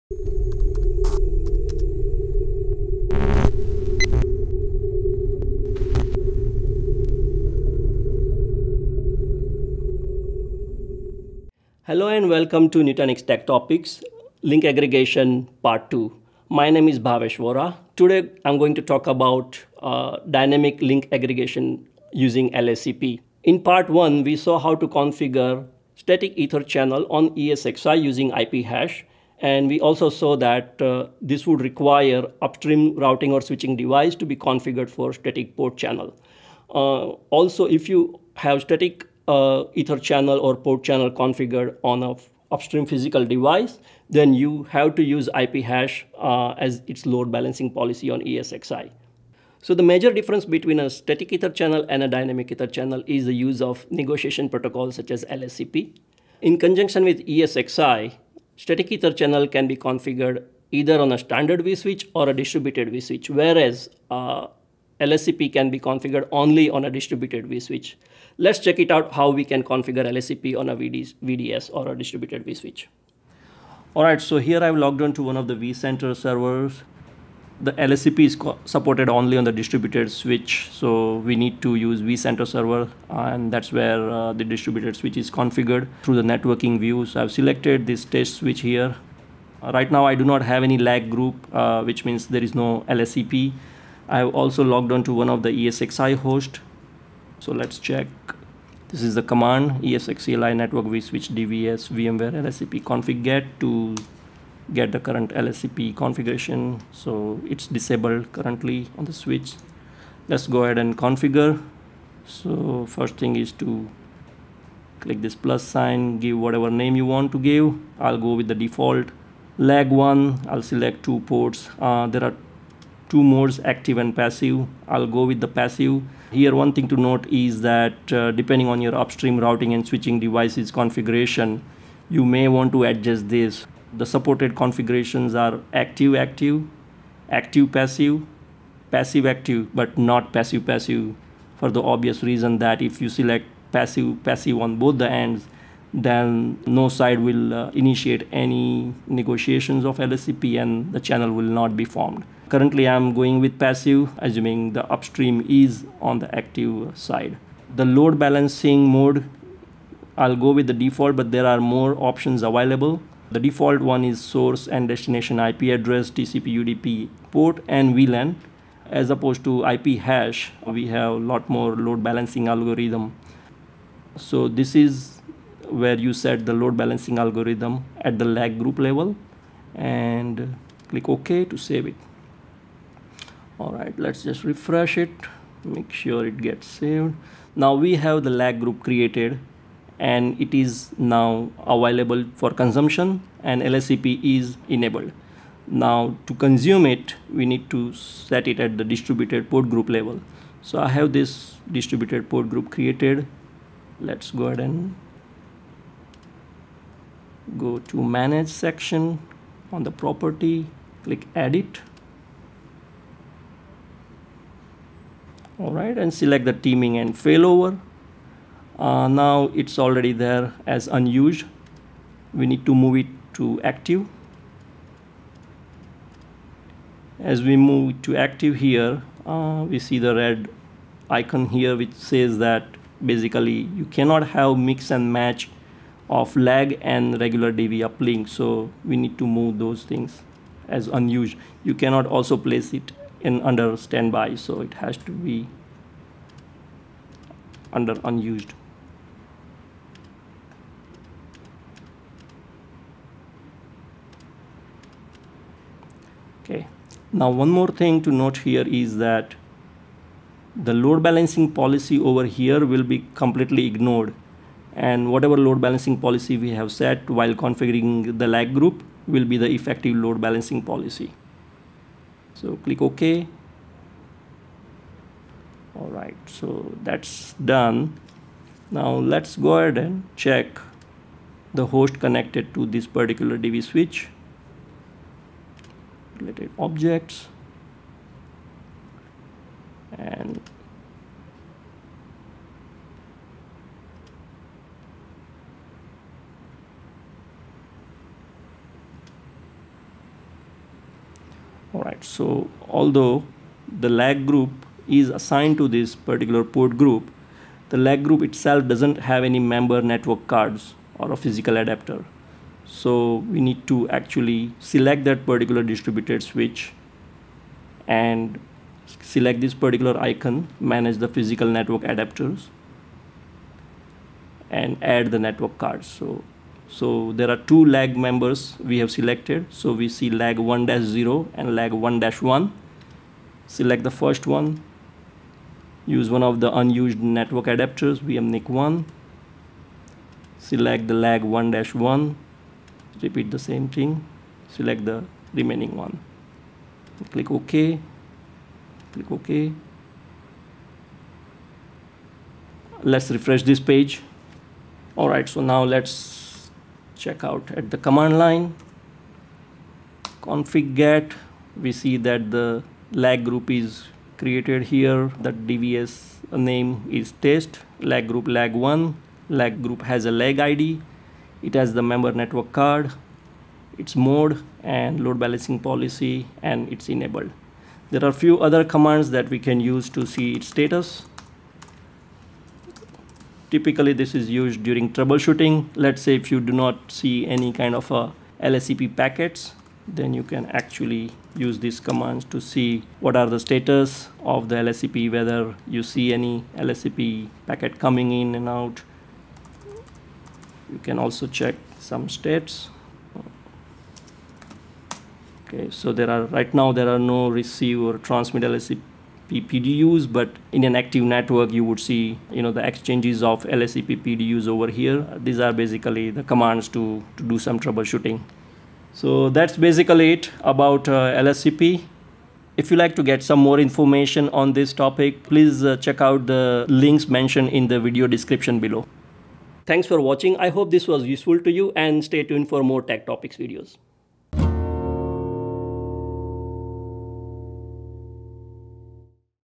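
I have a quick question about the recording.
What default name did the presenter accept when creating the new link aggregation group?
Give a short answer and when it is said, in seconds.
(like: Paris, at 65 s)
lag one, at 119 s.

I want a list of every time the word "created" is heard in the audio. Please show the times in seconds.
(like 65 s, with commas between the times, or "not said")
188 s, 202 s, 364 s.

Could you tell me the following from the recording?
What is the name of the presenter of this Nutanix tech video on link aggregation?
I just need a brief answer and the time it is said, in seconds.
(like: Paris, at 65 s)
Bhavesh Vora, at 16 s.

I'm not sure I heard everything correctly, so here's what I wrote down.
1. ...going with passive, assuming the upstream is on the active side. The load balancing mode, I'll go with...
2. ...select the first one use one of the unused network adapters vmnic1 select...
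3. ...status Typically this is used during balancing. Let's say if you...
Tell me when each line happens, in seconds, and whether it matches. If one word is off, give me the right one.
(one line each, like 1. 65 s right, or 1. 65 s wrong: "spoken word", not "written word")
1. 153 s right
2. 333 s right
3. 380 s wrong: "troubleshooting", not "balancing".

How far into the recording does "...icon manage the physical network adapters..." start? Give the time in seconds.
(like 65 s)
319 s.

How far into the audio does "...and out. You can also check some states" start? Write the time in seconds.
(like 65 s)
398 s.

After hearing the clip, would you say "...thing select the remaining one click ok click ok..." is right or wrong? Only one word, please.
right.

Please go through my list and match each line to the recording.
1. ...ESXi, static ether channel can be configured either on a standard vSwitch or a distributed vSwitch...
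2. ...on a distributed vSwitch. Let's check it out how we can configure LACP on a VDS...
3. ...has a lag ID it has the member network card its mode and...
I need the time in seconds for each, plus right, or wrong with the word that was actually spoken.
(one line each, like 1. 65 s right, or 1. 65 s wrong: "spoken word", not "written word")
1. 57 s right
2. 66 s right
3. 369 s right.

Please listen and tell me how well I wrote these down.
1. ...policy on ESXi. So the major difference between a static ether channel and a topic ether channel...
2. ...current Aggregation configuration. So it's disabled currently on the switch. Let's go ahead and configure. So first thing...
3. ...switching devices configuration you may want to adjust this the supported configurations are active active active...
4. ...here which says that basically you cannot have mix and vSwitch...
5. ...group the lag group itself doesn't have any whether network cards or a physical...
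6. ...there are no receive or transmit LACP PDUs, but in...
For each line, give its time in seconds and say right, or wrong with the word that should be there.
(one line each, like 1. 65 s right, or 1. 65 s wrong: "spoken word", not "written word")
1. 47 s wrong: "dynamic", not "topic"
2. 104 s wrong: "LACP", not "Aggregation"
3. 129 s right
4. 231 s wrong: "match", not "vSwitch"
5. 306 s wrong: "member", not "whether"
6. 406 s right.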